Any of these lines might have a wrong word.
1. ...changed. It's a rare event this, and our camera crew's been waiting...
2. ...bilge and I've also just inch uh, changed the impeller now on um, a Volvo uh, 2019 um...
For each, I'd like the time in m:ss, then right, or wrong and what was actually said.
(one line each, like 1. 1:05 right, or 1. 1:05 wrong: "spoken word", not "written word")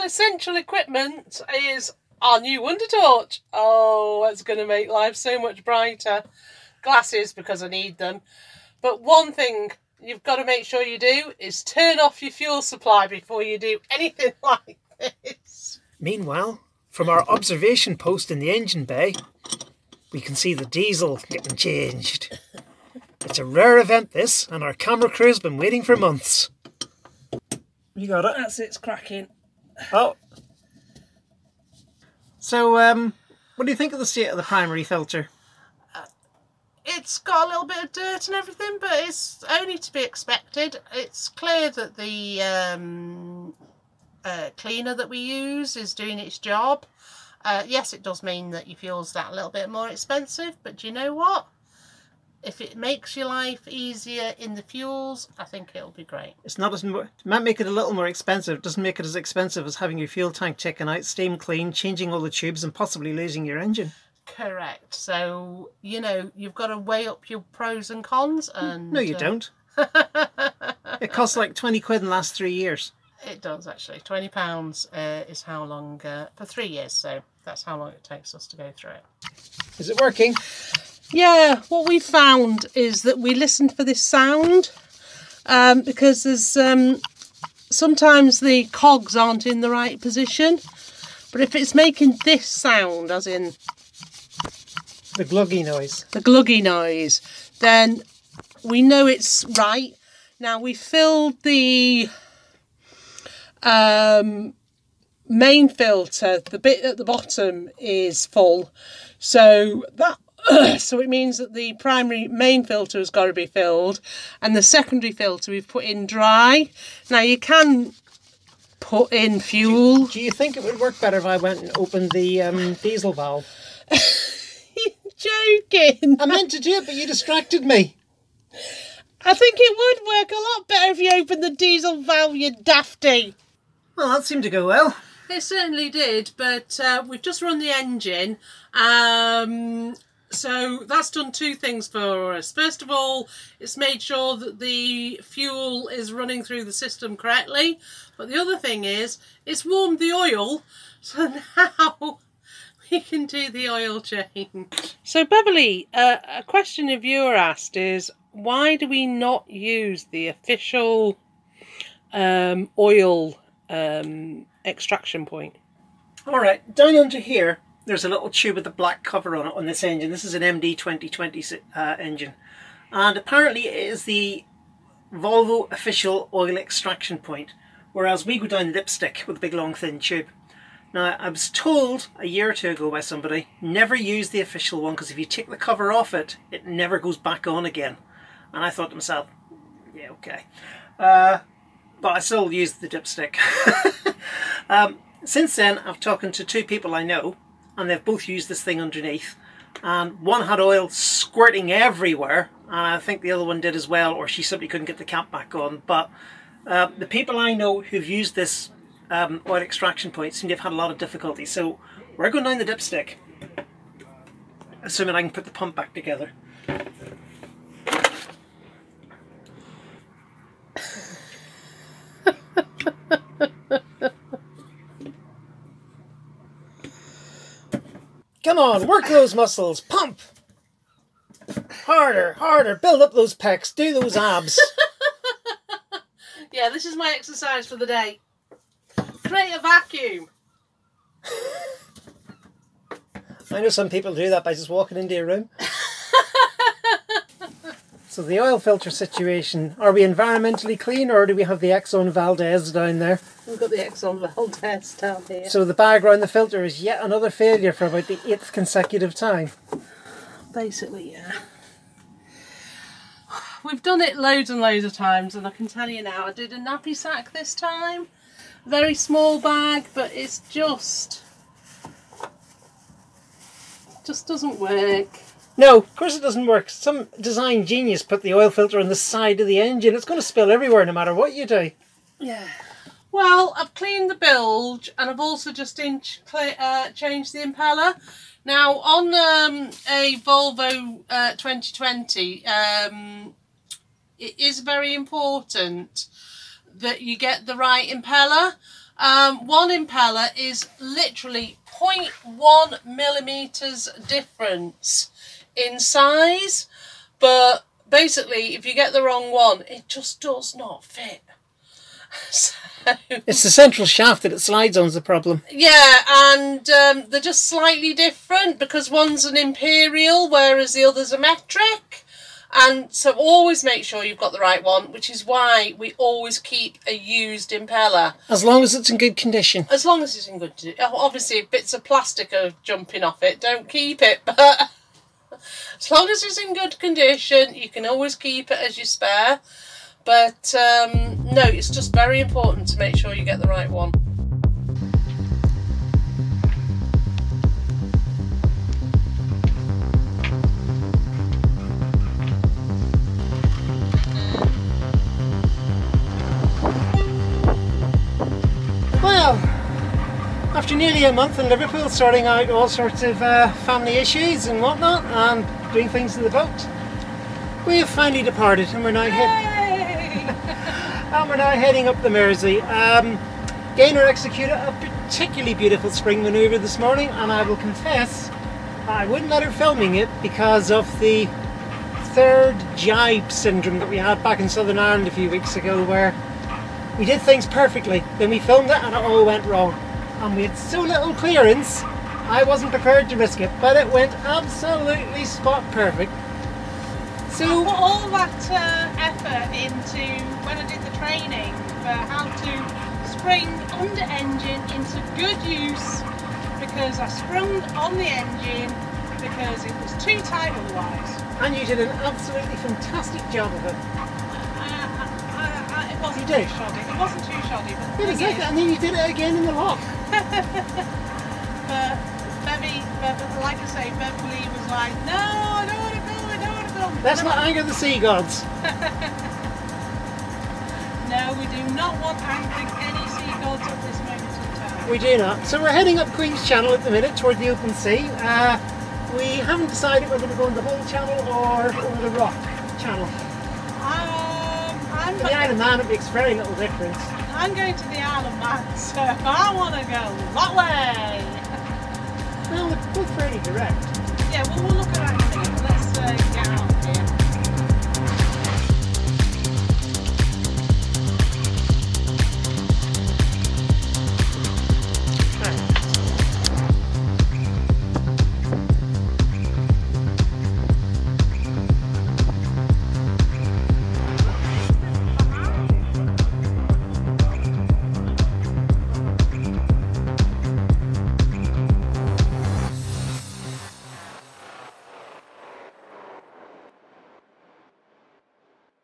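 1. 0:21 right
2. 4:44 wrong: "2020", not "2019".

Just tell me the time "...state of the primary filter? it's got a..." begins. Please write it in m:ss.
0:34.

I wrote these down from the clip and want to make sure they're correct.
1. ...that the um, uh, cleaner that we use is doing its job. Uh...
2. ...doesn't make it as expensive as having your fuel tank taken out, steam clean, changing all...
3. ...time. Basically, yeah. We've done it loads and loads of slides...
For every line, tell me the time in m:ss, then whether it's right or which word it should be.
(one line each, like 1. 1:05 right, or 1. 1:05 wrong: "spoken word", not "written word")
1. 0:41 right
2. 0:58 right
3. 4:19 wrong: "times", not "slides".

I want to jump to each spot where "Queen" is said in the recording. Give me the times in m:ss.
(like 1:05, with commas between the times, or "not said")
7:16.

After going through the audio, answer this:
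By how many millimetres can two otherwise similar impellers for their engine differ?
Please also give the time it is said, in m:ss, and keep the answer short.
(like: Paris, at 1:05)
0.1, at 5:01.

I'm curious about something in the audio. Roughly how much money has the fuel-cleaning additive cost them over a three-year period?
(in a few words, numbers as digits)
20 pounds.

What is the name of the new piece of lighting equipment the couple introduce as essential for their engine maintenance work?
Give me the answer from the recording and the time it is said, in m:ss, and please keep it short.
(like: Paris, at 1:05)
Wonder Torch, at 0:02.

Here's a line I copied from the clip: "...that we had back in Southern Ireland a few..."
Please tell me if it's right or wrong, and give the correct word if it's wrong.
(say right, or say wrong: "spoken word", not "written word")
right.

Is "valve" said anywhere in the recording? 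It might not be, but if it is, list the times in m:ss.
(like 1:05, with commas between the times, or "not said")
2:03, 2:12.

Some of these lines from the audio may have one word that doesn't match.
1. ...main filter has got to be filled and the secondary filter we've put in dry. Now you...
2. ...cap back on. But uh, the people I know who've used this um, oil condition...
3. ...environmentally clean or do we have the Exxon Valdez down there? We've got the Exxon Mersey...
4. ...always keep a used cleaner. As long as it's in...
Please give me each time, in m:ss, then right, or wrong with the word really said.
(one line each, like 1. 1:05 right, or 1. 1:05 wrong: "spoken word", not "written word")
1. 1:52 right
2. 3:25 wrong: "extraction", not "condition"
3. 4:10 wrong: "Valdez", not "Mersey"
4. 5:25 wrong: "impeller", not "cleaner".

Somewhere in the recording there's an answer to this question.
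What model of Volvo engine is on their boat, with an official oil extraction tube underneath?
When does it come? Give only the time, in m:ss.
2:50.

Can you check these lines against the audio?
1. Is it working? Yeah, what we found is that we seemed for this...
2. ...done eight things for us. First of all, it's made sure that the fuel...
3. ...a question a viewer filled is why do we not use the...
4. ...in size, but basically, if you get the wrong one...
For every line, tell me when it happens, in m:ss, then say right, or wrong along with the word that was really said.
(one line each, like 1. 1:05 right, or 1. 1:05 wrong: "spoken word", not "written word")
1. 1:19 wrong: "listened", not "seemed"
2. 2:21 wrong: "two", not "eight"
3. 2:36 wrong: "asked", not "filled"
4. 5:05 right.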